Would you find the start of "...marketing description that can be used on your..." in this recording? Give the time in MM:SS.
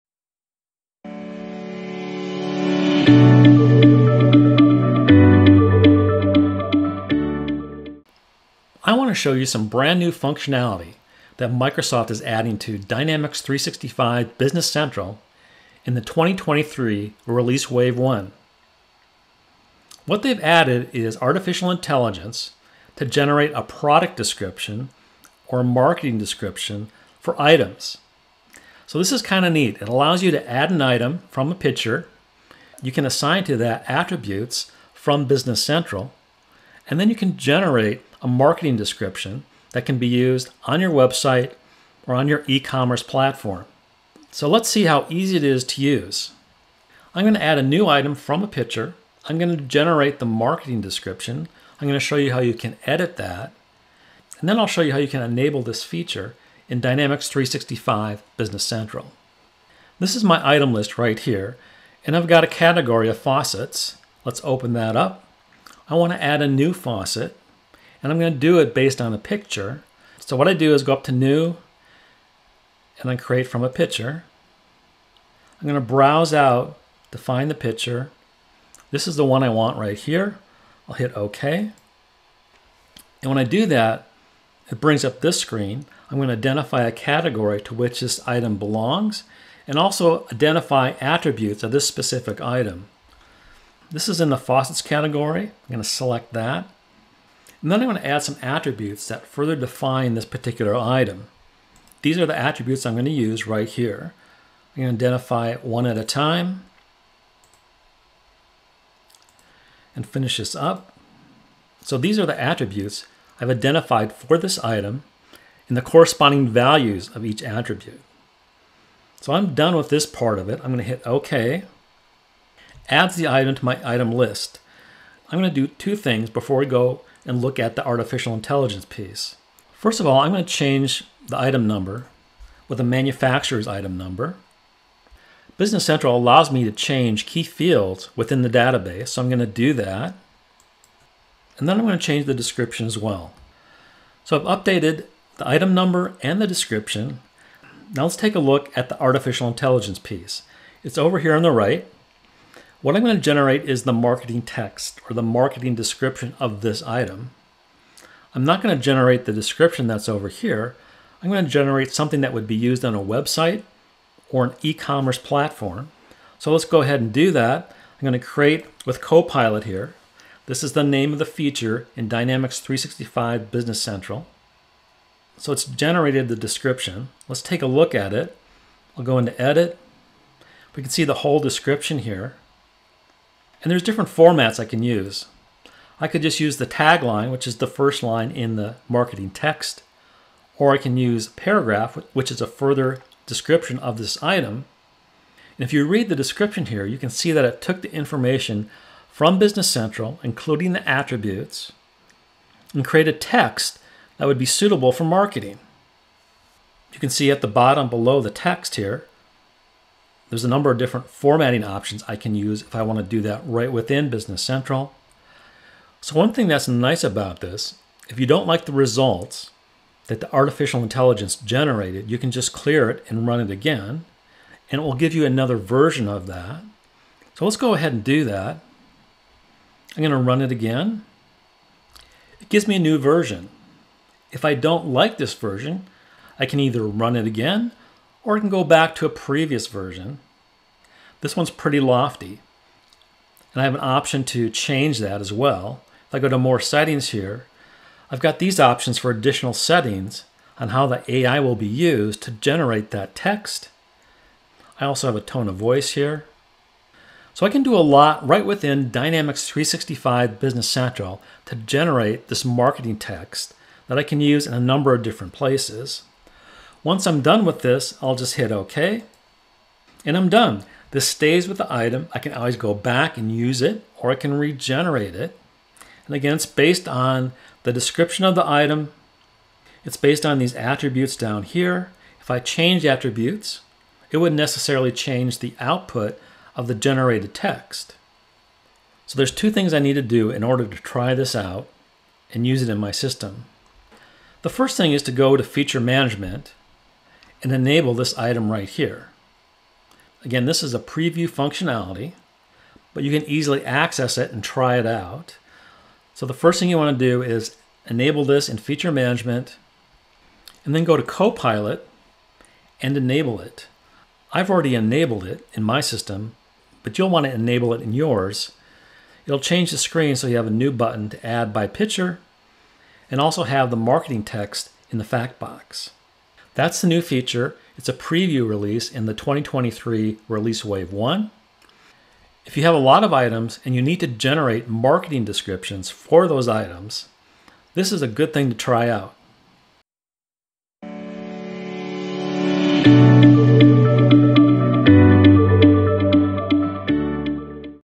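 00:38.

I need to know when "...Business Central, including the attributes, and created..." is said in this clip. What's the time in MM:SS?
03:19.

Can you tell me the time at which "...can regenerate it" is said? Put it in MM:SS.
04:34.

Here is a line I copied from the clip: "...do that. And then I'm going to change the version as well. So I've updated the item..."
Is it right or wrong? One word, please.
wrong.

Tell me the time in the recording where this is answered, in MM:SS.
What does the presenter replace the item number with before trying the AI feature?
02:12.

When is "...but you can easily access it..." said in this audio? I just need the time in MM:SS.
05:02.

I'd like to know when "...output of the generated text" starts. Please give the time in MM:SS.
04:45.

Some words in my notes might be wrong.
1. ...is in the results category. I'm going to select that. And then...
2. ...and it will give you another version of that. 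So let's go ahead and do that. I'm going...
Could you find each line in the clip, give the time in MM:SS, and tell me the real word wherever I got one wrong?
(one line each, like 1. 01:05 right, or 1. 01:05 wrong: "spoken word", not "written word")
1. 01:34 wrong: "faucets", not "results"
2. 03:44 right.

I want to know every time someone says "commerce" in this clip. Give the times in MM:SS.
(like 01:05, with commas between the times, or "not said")
00:42, 02:44.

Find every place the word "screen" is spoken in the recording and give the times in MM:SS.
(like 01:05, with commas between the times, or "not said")
01:25, 05:19.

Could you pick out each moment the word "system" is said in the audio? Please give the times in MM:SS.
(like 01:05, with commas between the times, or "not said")
04:52, 05:15.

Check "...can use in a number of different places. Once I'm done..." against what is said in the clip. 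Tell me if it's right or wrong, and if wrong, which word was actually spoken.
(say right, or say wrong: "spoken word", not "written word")
right.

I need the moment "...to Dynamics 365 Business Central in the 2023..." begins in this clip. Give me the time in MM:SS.
00:12.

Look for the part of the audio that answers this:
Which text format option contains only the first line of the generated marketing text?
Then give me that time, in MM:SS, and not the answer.
03:06.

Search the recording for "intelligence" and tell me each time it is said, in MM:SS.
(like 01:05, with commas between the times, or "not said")
00:21, 02:08, 02:29, 03:40.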